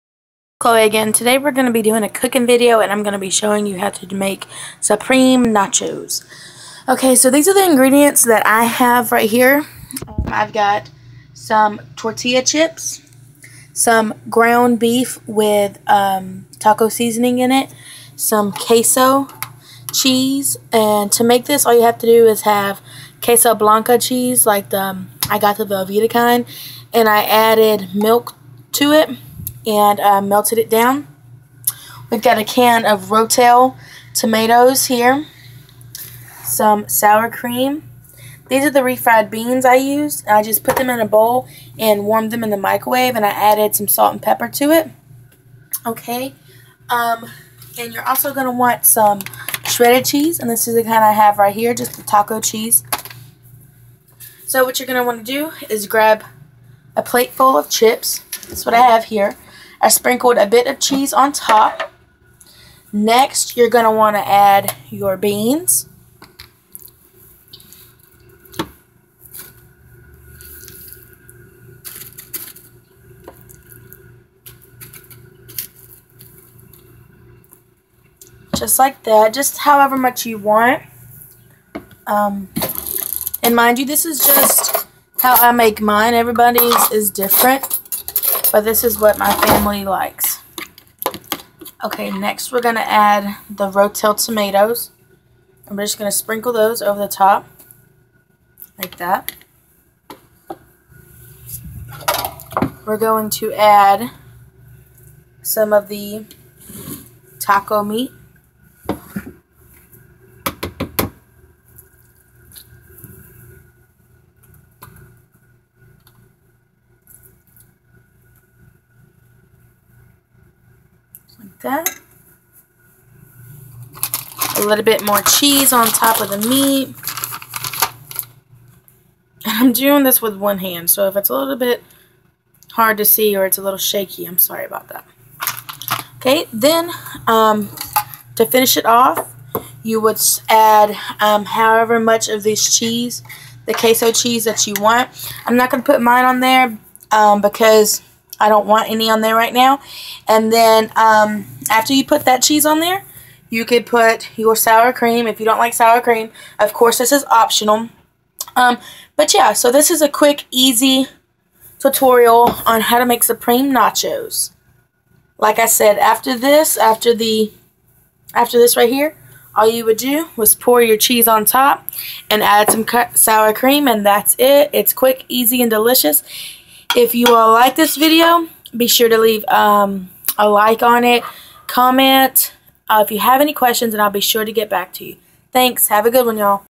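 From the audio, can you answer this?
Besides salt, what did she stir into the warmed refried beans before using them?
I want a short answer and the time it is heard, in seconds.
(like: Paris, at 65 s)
pepper, at 44 s.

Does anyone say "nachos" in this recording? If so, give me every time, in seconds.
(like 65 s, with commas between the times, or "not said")
5 s, 163 s.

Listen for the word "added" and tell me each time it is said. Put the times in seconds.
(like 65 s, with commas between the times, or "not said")
27 s, 43 s.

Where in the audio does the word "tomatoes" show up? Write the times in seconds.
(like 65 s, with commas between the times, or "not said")
34 s, 94 s.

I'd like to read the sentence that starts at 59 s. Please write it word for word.
I sprinkled a bit of cheese on top.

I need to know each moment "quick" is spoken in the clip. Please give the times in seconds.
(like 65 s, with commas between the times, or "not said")
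160 s, 174 s.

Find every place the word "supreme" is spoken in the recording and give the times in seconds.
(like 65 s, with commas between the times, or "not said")
4 s, 163 s.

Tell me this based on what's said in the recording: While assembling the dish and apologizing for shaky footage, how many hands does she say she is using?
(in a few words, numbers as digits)
1.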